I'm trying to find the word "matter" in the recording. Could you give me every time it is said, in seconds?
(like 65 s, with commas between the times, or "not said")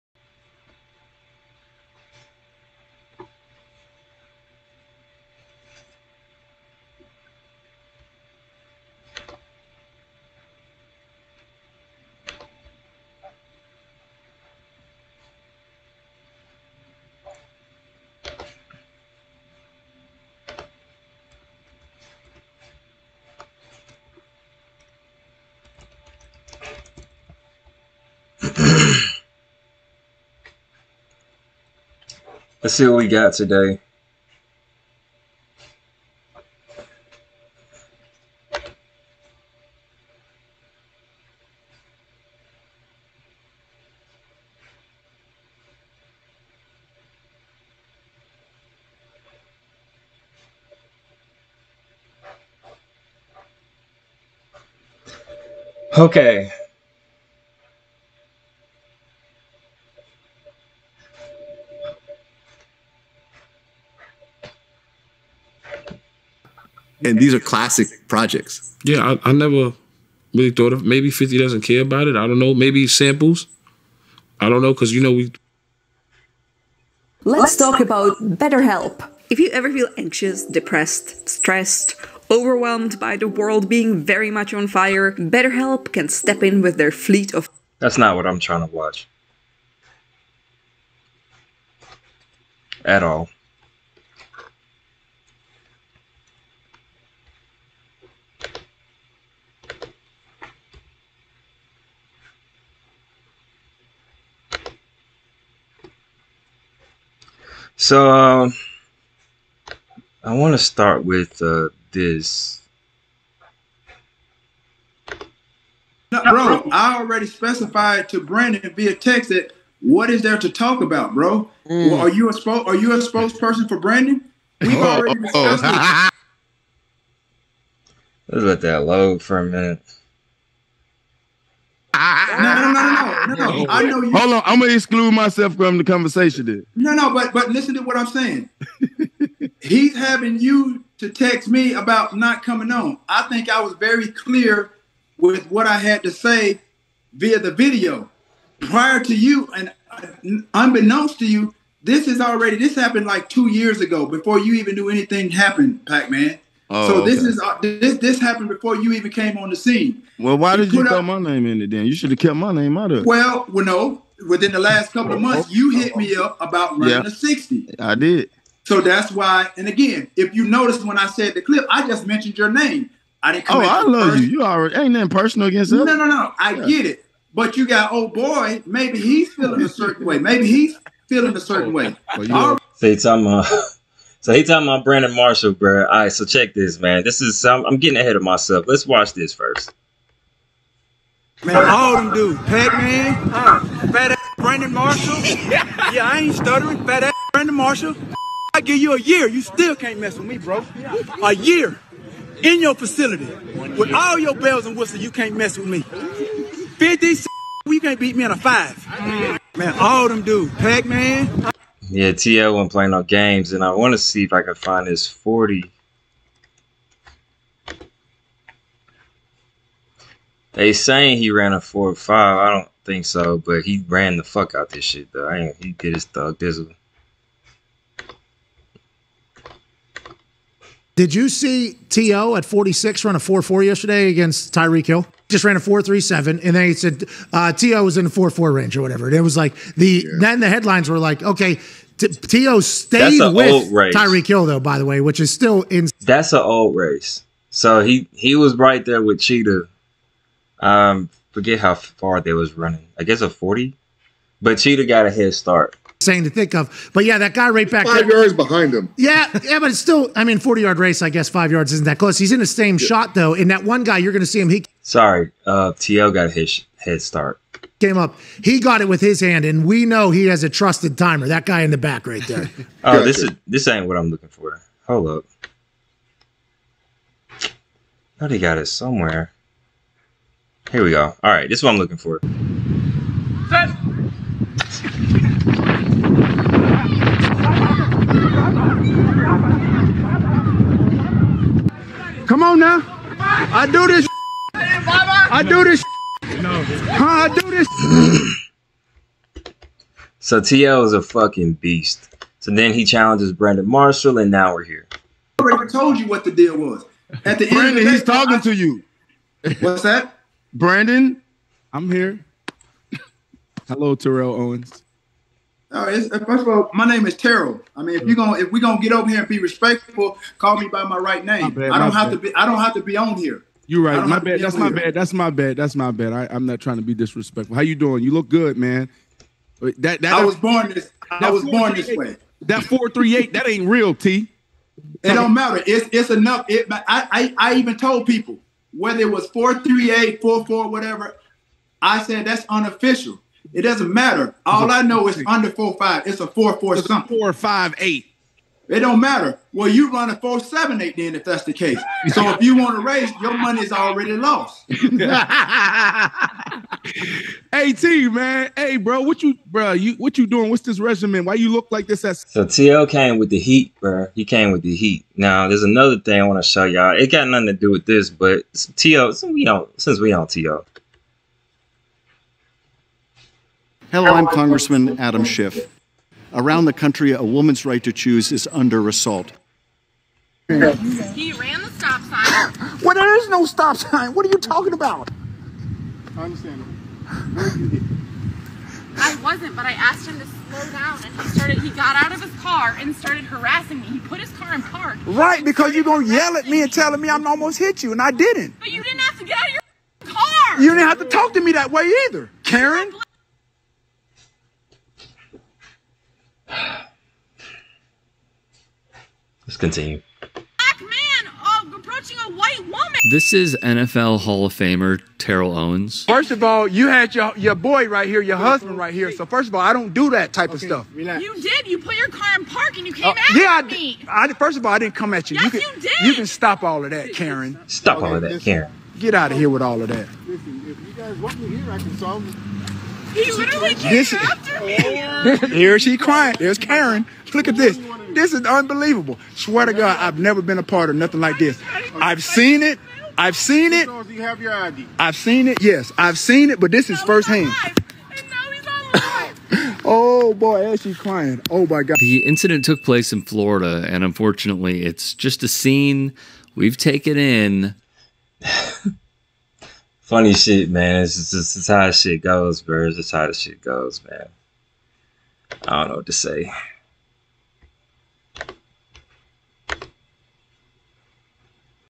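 335 s, 343 s, 349 s.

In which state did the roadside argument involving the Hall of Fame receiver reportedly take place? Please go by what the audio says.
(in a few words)
Florida.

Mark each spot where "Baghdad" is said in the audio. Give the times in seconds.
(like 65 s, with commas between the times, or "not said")
not said.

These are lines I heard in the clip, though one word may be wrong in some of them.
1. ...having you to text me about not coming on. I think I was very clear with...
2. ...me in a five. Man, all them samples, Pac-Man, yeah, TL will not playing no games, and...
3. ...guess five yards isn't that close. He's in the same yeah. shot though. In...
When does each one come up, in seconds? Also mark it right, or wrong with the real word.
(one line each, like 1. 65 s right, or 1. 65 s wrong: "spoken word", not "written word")
1. 139 s right
2. 208 s wrong: "dudes", not "samples"
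3. 261 s right.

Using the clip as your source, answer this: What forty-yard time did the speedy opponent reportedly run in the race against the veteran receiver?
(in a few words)
4.37.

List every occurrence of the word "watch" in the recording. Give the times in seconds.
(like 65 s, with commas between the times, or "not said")
88 s, 188 s.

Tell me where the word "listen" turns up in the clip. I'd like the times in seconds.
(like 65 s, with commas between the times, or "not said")
137 s, 430 s.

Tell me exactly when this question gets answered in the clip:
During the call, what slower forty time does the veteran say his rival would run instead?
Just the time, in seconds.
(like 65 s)
350 s.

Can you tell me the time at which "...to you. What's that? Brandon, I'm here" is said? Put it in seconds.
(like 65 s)
308 s.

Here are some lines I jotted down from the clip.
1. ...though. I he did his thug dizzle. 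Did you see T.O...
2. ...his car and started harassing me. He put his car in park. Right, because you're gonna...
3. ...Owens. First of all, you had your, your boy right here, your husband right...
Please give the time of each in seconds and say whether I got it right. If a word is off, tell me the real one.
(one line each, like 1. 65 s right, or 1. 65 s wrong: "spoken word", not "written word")
1. 225 s right
2. 392 s right
3. 415 s right.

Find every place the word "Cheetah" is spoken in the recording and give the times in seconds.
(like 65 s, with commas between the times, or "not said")
249 s, 254 s.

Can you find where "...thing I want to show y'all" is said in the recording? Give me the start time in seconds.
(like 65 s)
365 s.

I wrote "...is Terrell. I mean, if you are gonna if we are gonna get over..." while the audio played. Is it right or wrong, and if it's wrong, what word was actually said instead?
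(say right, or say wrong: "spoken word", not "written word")
right.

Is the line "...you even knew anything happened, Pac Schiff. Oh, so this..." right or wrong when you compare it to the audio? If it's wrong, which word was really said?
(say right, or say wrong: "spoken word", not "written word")
wrong: "Man", not "Schiff".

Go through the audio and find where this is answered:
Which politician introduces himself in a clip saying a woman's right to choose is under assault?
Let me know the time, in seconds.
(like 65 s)
374 s.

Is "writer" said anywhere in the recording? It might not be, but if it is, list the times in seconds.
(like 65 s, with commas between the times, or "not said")
not said.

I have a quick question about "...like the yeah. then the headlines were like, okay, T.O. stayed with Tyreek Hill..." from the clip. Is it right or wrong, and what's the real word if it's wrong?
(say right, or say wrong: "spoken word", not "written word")
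right.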